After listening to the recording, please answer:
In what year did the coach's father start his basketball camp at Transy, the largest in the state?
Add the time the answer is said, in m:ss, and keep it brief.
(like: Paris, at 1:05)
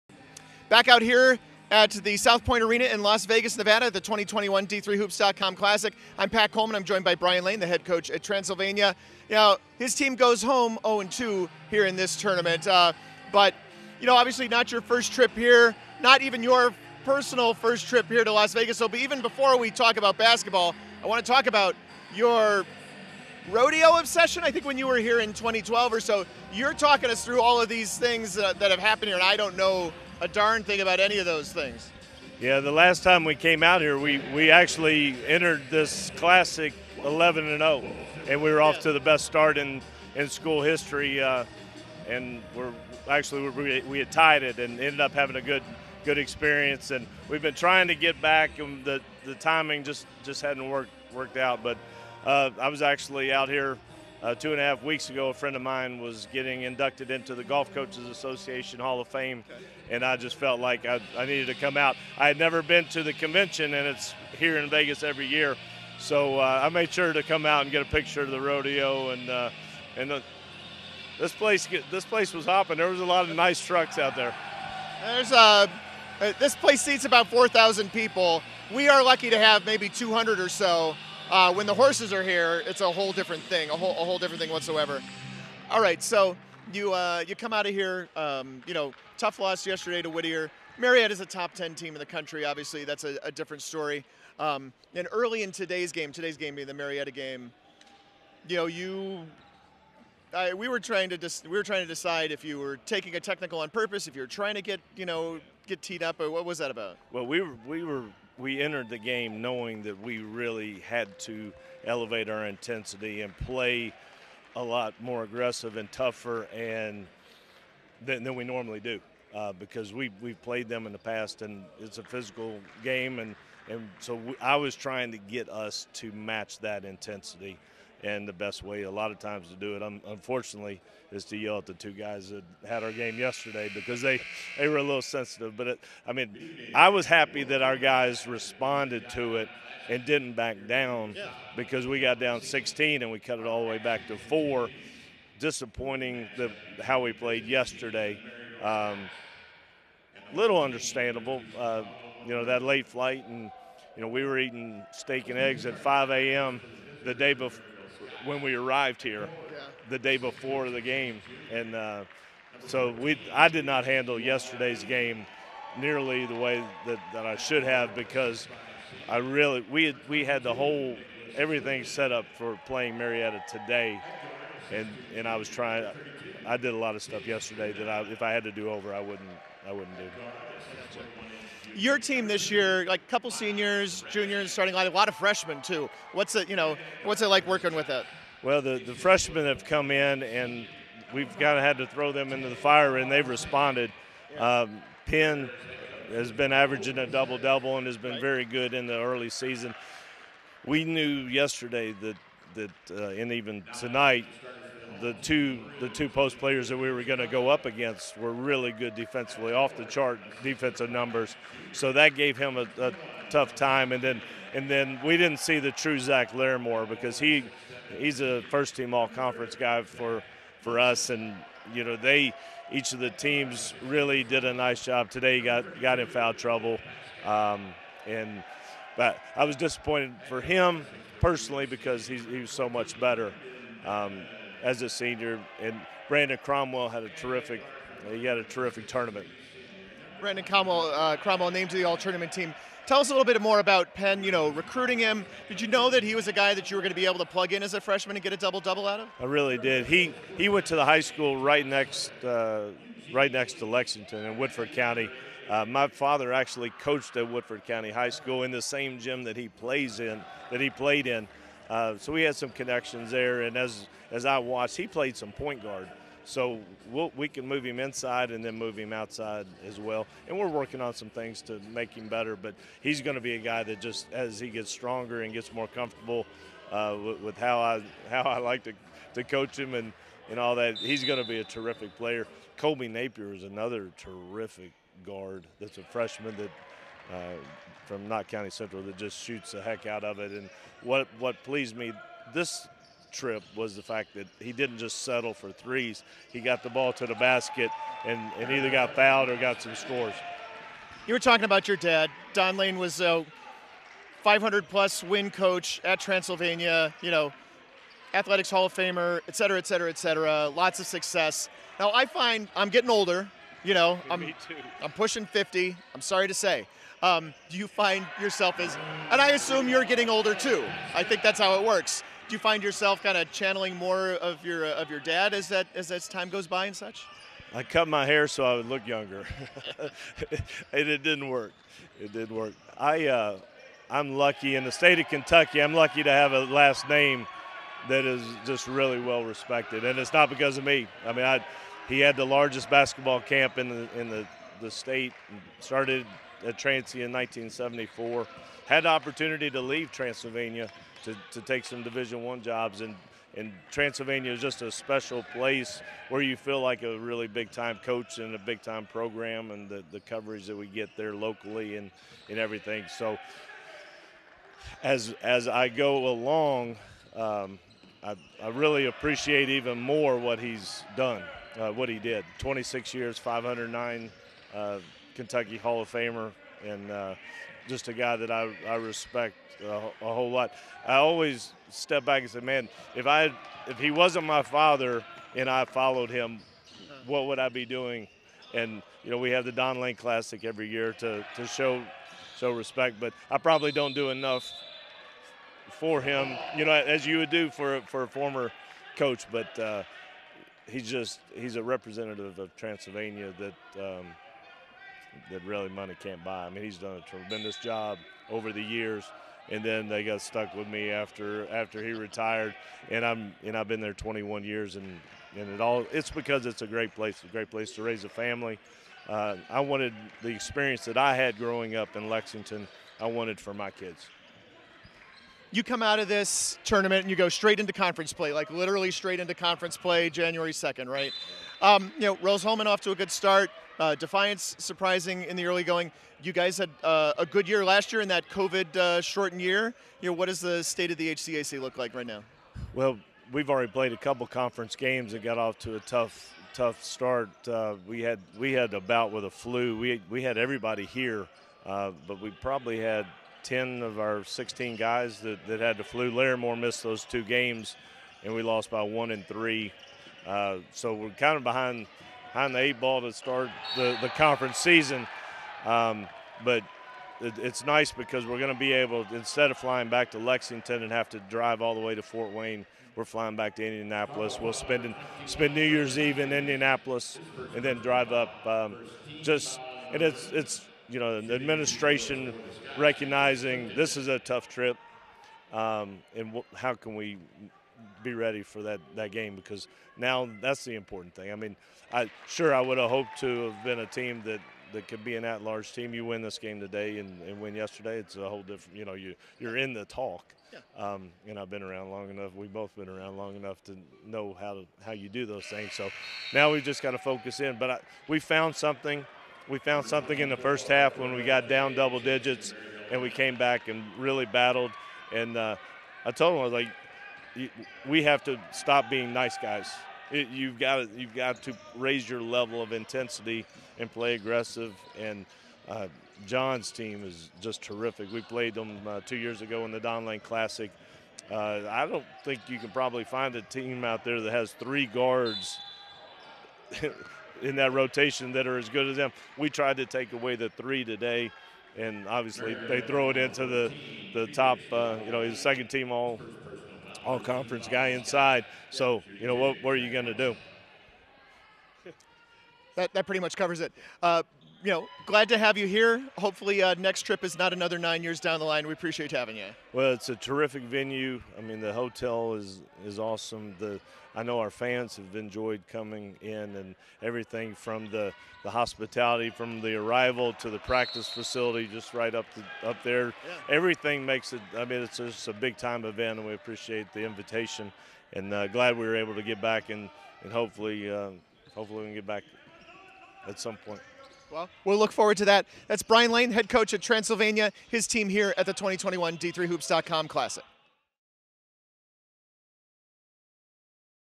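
1974, at 5:47.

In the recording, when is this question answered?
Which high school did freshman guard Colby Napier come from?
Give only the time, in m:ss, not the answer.
4:48.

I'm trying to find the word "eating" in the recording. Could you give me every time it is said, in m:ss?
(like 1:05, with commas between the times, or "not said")
2:34.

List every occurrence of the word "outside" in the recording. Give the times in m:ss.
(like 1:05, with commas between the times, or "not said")
4:28.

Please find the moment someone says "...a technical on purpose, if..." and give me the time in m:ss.
1:43.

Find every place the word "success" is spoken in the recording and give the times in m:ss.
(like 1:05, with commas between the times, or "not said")
5:10.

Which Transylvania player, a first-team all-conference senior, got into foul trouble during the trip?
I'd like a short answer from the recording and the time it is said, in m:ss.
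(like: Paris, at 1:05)
Zach Larimore, at 3:35.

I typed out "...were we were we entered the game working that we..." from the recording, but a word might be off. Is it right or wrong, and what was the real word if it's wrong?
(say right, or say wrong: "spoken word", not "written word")
wrong: "knowing", not "working".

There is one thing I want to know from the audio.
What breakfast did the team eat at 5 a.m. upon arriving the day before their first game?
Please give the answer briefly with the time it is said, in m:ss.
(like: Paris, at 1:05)
Steak and eggs, at 2:34.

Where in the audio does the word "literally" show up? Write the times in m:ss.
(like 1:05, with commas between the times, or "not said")
7:08.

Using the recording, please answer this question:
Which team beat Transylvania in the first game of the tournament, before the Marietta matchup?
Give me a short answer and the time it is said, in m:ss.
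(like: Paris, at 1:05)
Whittier, at 1:30.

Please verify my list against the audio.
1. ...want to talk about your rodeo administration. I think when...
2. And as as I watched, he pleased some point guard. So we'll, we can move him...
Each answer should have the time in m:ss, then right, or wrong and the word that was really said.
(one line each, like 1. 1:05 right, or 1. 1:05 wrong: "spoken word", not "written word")
1. 0:21 wrong: "obsession", not "administration"
2. 4:23 wrong: "played", not "pleased".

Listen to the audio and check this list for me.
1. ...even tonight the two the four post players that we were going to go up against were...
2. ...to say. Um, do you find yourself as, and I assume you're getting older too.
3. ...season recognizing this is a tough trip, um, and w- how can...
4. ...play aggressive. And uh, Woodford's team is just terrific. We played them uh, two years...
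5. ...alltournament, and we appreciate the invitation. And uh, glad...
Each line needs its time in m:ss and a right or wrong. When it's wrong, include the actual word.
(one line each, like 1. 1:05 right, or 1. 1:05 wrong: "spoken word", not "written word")
1. 3:23 wrong: "two", not "four"
2. 5:16 right
3. 8:01 wrong: "administration", not "season"
4. 8:43 wrong: "John", not "Woodford"
5. 9:35 wrong: "event", not "alltournament".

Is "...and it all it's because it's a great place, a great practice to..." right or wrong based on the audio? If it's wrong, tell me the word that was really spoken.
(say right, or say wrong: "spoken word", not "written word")
wrong: "place", not "practice".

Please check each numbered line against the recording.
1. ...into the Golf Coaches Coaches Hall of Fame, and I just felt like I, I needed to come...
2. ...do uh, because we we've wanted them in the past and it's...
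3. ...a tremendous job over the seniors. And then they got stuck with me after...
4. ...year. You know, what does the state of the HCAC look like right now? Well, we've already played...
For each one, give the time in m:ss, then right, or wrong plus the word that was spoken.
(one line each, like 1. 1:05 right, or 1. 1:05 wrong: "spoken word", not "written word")
1. 0:57 wrong: "Association", not "Coaches"
2. 1:58 wrong: "played", not "wanted"
3. 6:47 wrong: "years", not "seniors"
4. 7:19 right.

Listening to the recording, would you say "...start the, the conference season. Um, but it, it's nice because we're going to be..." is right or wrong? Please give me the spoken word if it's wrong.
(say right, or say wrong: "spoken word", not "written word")
right.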